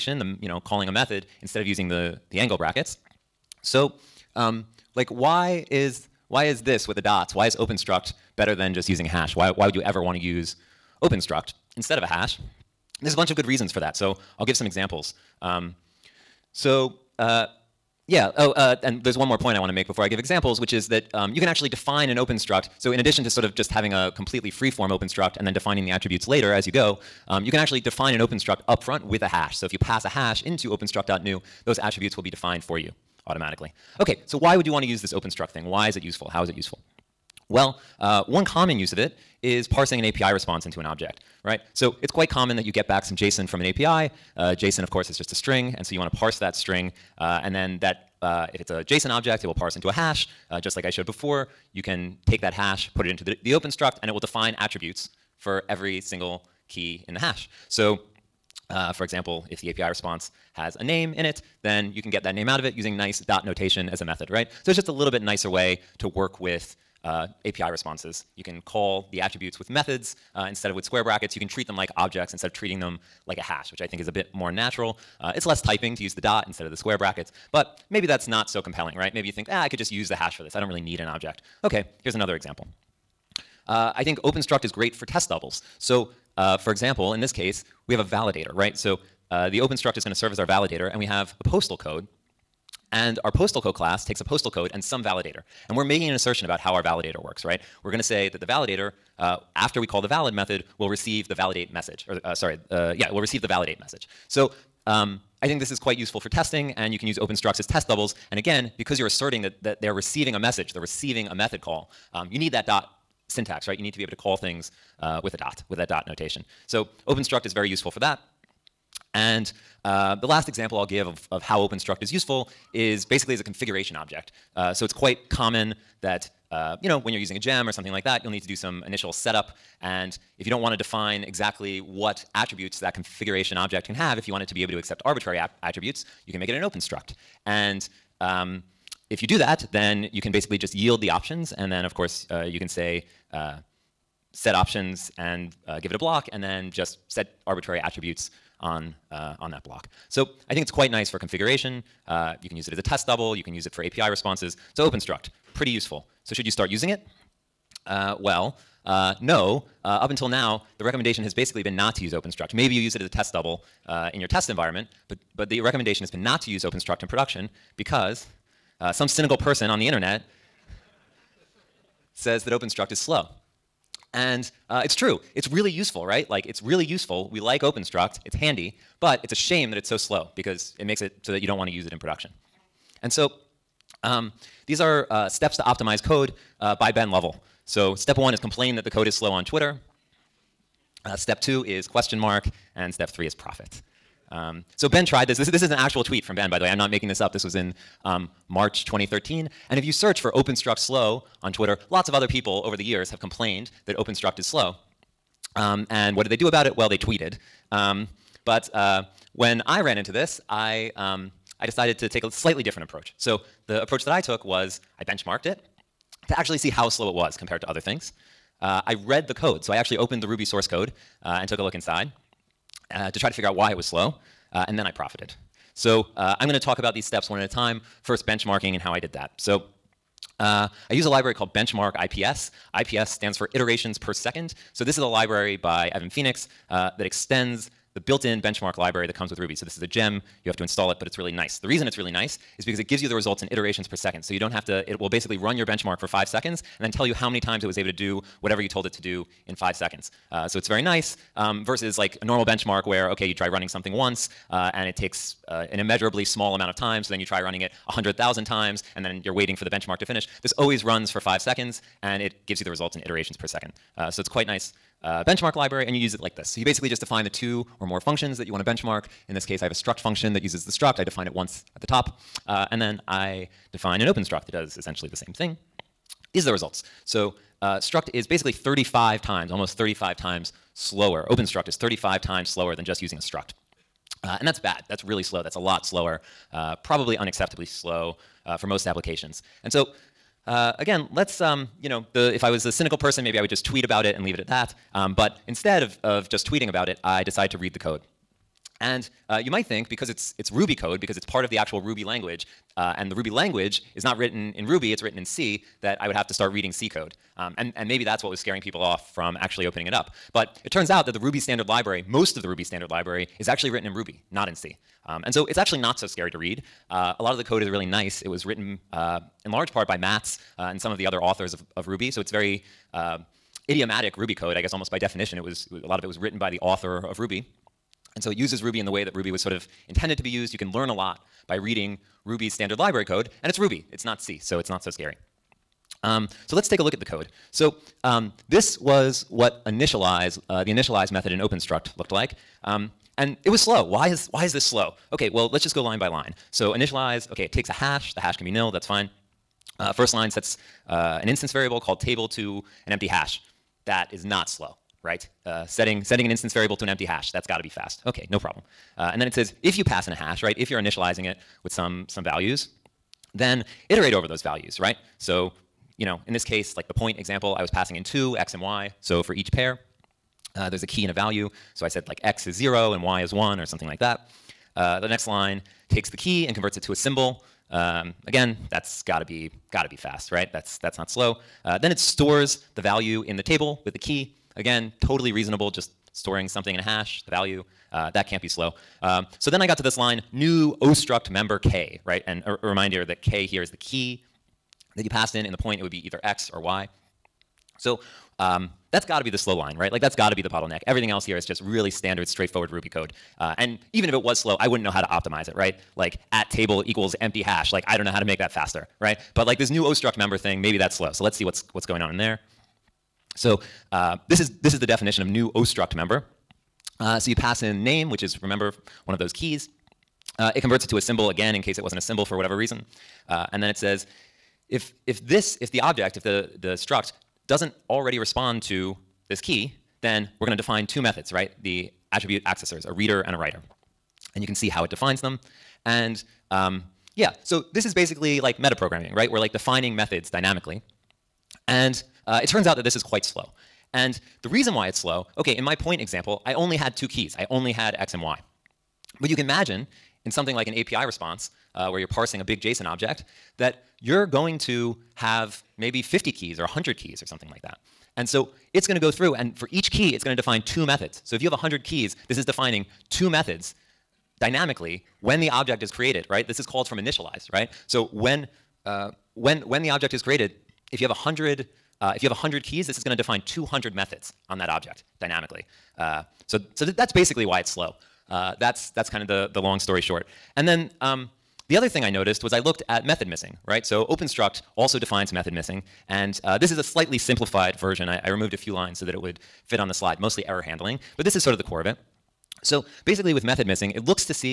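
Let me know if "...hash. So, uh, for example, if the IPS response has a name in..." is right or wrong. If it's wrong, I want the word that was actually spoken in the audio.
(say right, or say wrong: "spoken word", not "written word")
wrong: "API", not "IPS".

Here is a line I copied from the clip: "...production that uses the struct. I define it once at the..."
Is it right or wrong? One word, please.
wrong.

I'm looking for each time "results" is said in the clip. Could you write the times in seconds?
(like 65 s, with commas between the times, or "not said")
243 s, 262 s, 276 s.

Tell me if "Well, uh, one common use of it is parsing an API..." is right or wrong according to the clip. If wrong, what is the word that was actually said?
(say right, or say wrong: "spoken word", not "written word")
right.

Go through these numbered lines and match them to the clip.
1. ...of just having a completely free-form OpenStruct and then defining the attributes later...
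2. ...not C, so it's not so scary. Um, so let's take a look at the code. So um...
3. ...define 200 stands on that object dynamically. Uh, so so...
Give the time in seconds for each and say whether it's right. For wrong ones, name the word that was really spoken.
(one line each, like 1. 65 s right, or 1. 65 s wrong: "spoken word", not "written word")
1. 23 s right
2. 334 s right
3. 473 s wrong: "methods", not "stands".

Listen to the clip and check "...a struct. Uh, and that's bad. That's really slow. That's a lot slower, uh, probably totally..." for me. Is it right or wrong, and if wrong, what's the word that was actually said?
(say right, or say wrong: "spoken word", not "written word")
wrong: "unacceptably", not "totally".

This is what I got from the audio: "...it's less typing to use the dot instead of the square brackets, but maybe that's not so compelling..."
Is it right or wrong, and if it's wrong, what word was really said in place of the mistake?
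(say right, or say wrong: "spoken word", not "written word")
right.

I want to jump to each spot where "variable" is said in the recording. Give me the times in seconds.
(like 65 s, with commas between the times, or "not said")
351 s, 356 s.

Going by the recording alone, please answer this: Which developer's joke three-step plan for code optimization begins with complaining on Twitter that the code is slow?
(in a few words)
Ben Lovell.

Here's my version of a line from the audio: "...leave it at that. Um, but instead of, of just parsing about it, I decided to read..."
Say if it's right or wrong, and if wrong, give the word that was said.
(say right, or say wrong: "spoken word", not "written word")
wrong: "tweeting", not "parsing".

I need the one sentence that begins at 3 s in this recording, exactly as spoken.
So, um, like, why is, why is this with the dots?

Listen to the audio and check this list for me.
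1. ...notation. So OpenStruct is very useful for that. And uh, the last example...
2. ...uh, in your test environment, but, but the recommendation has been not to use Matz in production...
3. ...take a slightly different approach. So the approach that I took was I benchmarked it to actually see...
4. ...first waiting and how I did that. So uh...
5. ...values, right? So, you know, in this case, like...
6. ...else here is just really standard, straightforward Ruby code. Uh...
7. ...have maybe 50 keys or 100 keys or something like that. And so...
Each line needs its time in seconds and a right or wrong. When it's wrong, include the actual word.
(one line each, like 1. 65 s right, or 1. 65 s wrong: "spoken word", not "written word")
1. 116 s right
2. 163 s wrong: "OpenStruct", not "Matz"
3. 212 s right
4. 228 s wrong: "benchmarking", not "waiting"
5. 364 s right
6. 401 s right
7. 455 s right.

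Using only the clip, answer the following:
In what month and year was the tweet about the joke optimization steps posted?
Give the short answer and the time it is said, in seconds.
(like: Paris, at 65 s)
March 2013, at 198 s.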